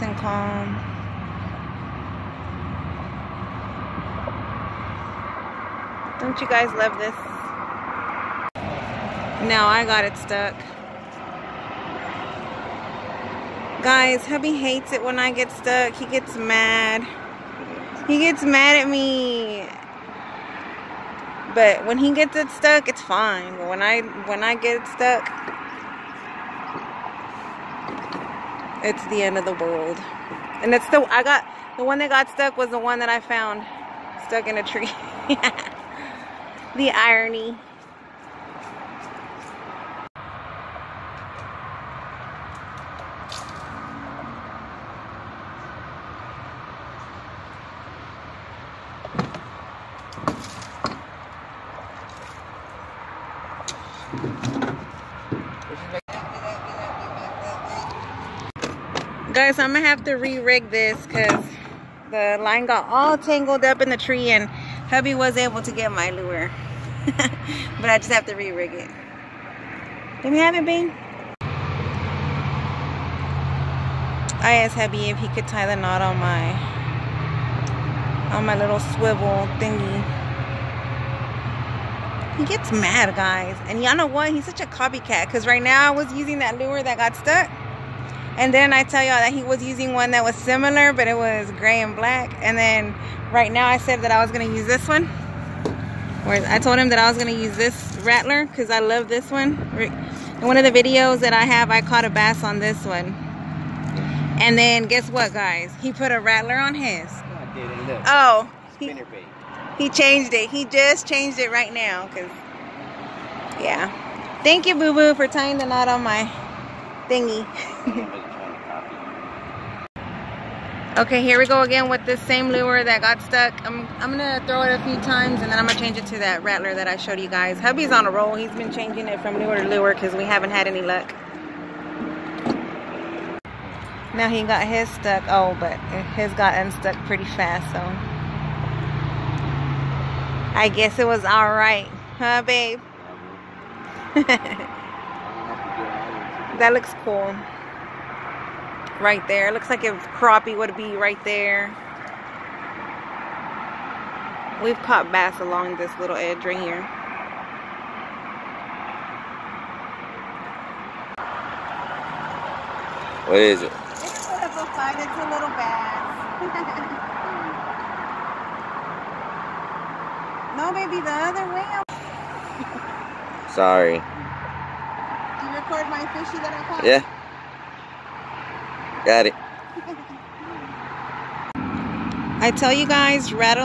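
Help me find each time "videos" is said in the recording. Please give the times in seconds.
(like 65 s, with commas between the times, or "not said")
100 s.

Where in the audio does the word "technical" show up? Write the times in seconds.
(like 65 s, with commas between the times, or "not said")
not said.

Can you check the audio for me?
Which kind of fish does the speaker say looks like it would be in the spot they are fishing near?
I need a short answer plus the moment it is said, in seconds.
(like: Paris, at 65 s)
Crappie, at 150 s.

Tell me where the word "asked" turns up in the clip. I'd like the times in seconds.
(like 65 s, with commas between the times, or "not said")
74 s.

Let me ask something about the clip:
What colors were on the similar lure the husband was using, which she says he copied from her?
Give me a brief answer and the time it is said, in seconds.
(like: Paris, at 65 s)
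Gray and black, at 91 s.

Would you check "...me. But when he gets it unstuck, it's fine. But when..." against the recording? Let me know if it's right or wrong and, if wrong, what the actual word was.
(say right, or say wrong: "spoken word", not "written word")
wrong: "stuck", not "unstuck".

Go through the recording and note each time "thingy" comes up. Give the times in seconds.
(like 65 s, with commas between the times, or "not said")
79 s, 117 s.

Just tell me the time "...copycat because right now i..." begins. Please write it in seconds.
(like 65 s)
84 s.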